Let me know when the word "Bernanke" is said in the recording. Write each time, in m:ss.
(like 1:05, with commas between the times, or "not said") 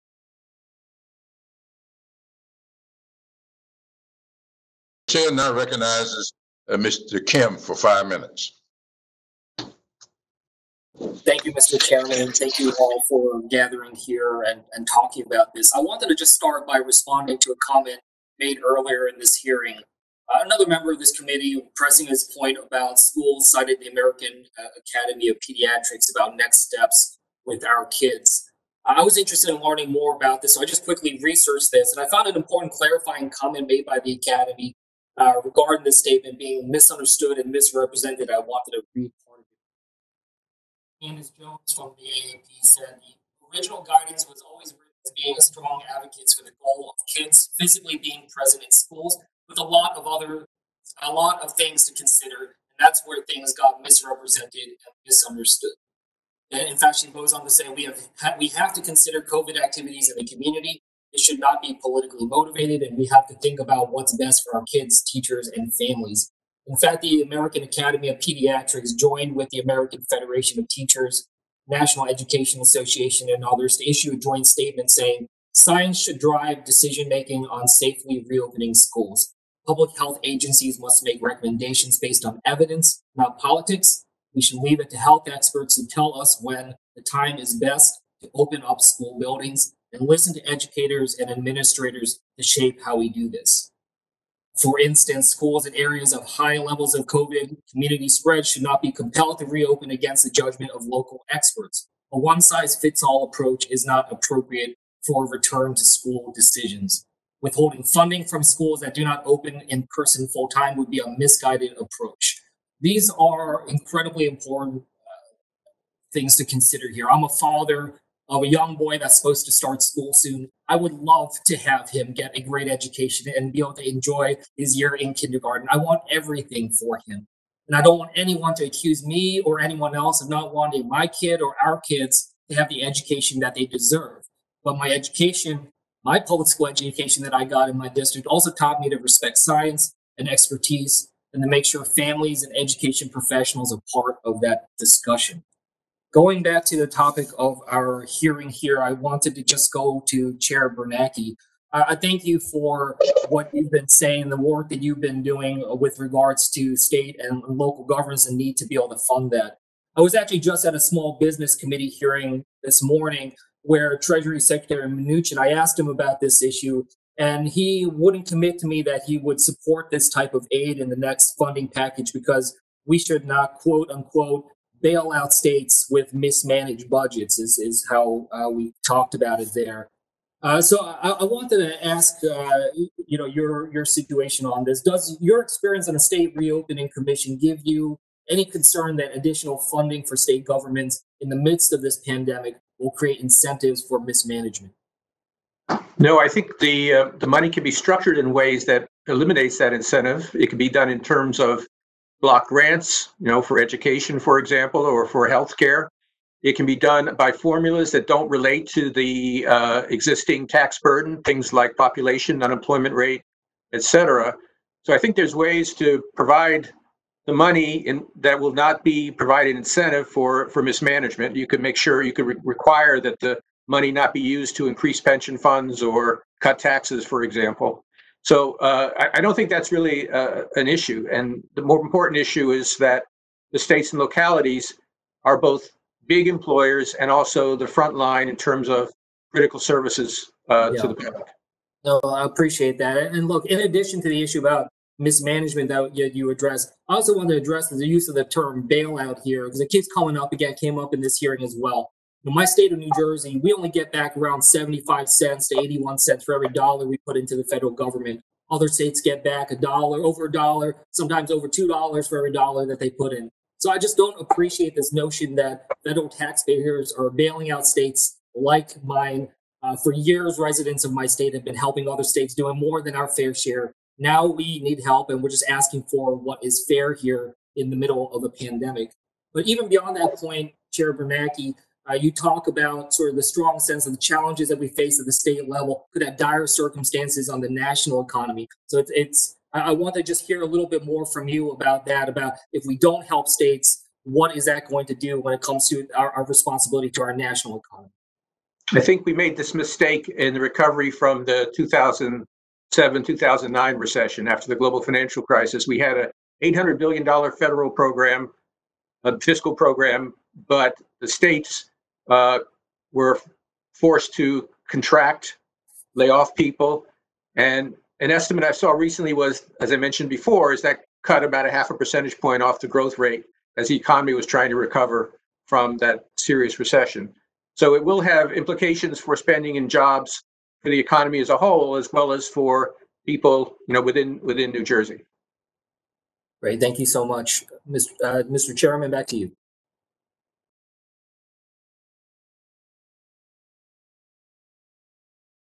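2:30, 4:40.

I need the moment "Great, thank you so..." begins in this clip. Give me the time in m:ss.
5:36.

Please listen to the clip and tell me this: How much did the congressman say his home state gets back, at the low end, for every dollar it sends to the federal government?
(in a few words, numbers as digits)
75 cents.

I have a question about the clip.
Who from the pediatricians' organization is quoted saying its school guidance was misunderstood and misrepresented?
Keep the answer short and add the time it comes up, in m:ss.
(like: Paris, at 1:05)
Candace Jones, at 0:41.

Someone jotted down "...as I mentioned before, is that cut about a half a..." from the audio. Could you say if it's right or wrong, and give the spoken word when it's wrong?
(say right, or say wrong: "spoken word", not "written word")
right.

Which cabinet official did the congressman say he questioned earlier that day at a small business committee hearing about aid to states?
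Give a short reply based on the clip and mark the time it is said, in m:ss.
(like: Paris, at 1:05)
Treasury Secretary Mnuchin, at 2:43.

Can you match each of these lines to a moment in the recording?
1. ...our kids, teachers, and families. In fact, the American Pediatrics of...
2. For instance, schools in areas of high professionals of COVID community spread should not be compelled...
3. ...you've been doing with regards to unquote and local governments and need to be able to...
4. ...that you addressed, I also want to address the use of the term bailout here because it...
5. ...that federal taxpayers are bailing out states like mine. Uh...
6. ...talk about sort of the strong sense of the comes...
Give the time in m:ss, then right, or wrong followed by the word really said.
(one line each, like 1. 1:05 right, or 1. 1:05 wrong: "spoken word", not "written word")
1. 1:04 wrong: "Academy", not "Pediatrics"
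2. 1:34 wrong: "levels", not "professionals"
3. 2:34 wrong: "state", not "unquote"
4. 4:05 right
5. 4:25 right
6. 4:42 wrong: "challenges", not "comes".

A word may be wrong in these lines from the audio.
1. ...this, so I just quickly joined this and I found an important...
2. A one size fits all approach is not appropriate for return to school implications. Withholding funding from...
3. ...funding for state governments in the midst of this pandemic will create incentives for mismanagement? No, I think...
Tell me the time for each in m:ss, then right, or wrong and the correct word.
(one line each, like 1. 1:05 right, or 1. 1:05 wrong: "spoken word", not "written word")
1. 0:30 wrong: "researched", not "joined"
2. 1:42 wrong: "decisions", not "implications"
3. 3:09 right.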